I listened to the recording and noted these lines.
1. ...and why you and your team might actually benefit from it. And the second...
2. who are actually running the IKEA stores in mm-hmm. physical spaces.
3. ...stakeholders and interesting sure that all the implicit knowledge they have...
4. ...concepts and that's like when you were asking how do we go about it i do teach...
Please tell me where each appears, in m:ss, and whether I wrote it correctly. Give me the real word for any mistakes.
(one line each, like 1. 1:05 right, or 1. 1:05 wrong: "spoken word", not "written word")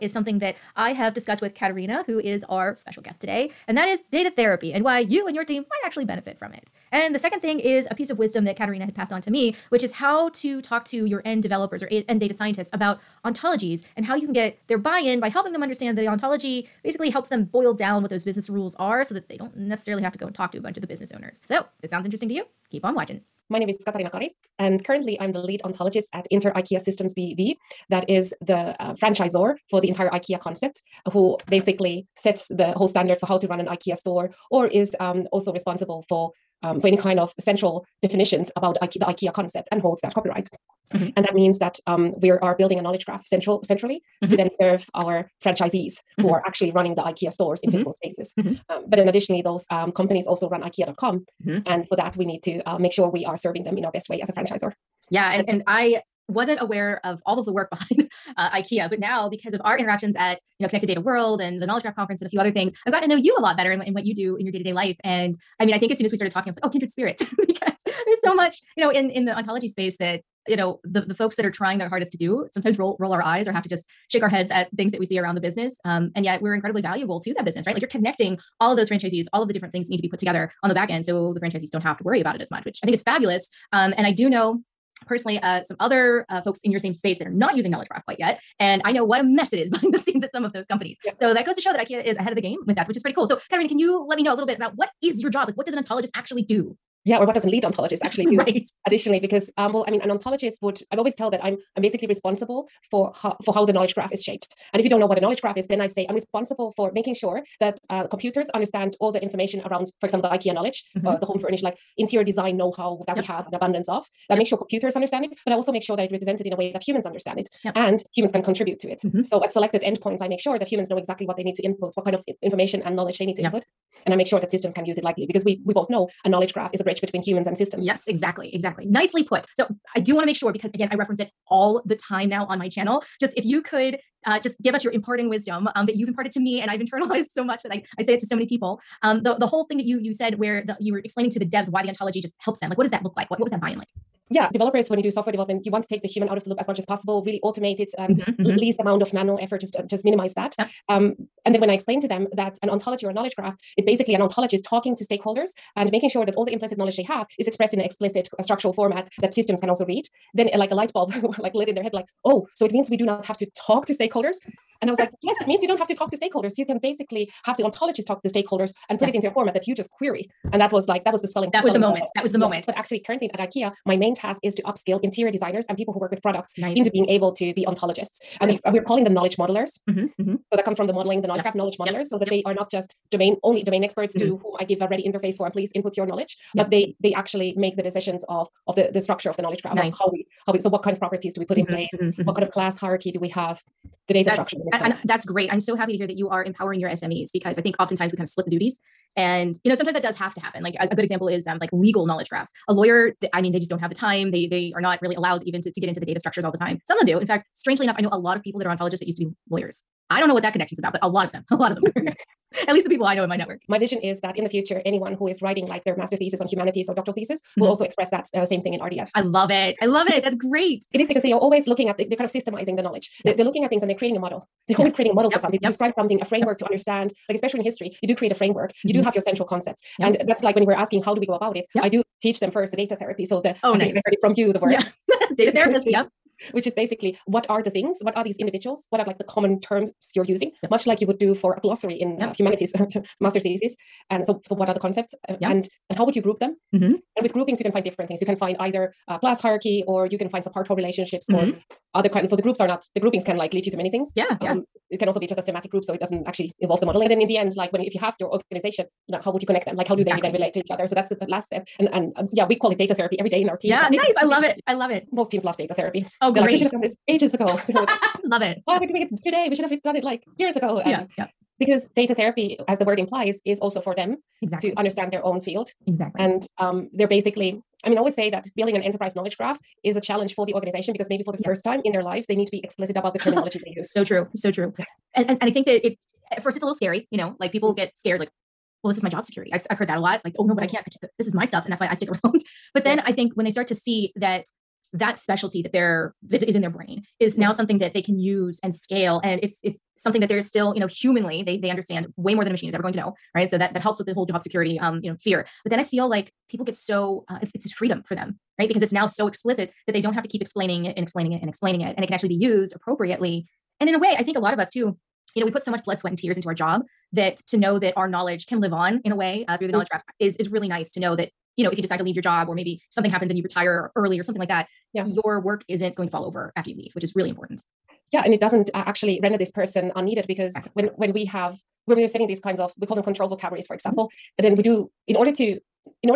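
1. 0:04 right
2. 0:46 right
3. 2:35 wrong: "making", not "interesting"
4. 3:49 right.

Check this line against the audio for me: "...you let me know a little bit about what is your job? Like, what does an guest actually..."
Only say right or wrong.
wrong.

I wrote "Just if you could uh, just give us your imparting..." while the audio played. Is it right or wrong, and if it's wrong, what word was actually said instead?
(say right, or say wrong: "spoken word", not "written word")
right.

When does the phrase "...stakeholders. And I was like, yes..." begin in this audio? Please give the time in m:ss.
2:43.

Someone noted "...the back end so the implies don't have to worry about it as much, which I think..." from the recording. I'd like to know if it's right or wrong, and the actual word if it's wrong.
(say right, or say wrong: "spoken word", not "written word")
wrong: "franchisees", not "implies".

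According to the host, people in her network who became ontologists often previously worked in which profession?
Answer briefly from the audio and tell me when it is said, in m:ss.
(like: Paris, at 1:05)
lawyers, at 3:29.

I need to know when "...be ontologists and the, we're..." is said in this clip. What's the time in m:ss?
2:57.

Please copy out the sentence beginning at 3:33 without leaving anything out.
My vision is that in the future, anyone who is writing like their master thesis on humanities or doctoral thesis mm-hmm.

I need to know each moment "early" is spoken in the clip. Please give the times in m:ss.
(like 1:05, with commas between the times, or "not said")
5:23.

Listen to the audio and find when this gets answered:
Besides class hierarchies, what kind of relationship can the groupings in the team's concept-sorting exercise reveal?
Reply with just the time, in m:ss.
4:10.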